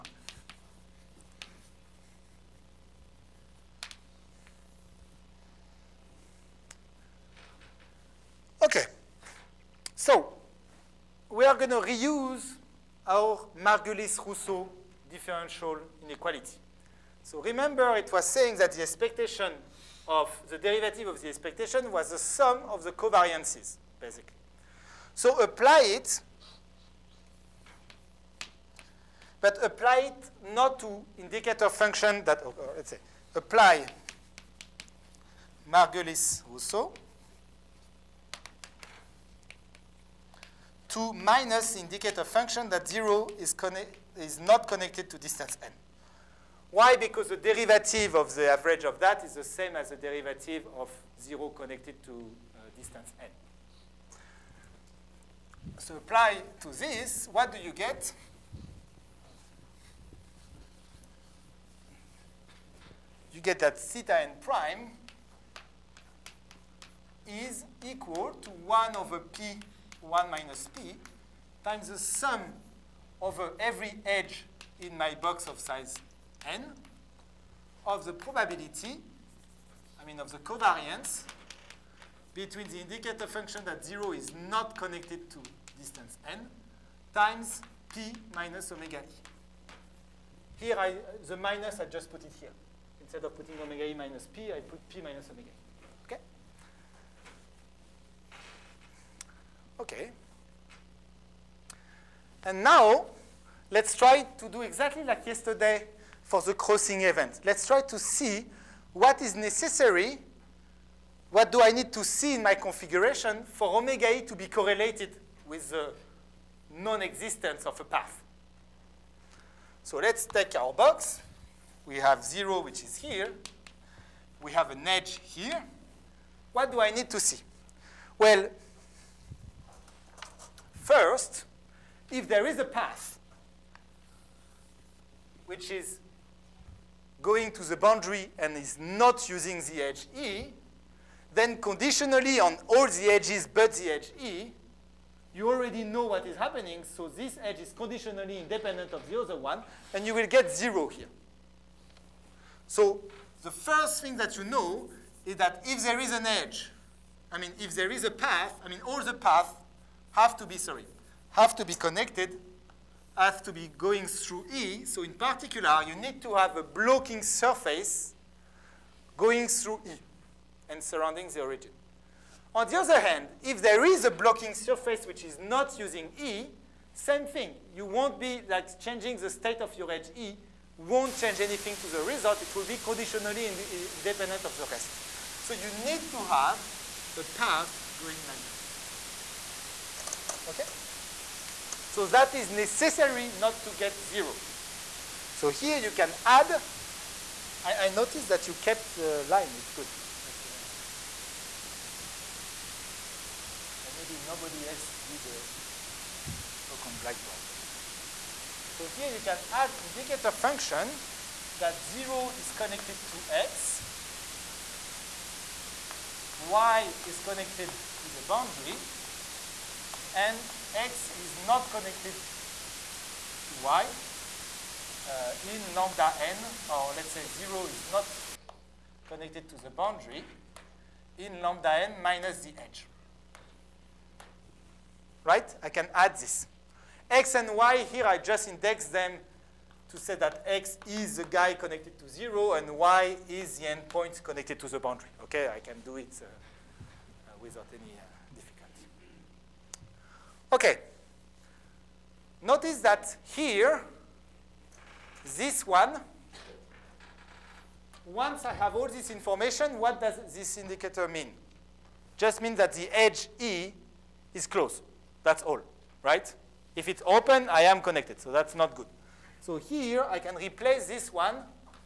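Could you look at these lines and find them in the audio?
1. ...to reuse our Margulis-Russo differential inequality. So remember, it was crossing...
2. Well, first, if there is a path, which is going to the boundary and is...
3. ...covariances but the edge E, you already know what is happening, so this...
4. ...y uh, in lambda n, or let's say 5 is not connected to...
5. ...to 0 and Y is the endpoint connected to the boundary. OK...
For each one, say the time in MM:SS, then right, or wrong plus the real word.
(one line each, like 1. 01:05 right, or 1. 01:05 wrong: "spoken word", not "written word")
1. 00:11 wrong: "saying", not "crossing"
2. 02:08 right
3. 02:23 wrong: "edges", not "covariances"
4. 03:43 wrong: "0", not "5"
5. 04:01 right.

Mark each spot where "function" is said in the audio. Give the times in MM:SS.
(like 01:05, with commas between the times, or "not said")
00:31, 00:42, 01:23, 03:30.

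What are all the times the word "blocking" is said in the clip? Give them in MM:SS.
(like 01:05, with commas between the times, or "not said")
02:46, 02:54.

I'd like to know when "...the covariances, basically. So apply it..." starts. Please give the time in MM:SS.
00:22.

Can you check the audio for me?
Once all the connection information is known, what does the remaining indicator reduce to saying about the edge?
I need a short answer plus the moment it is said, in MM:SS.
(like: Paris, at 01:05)
edge E is closed, at 04:22.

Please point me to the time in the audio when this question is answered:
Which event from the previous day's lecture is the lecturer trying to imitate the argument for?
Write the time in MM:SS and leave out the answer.
01:46.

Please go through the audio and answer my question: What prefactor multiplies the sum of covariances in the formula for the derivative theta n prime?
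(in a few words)
1 over p(1 minus p).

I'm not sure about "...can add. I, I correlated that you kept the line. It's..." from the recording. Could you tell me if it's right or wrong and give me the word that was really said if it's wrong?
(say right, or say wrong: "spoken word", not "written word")
wrong: "noticed", not "correlated".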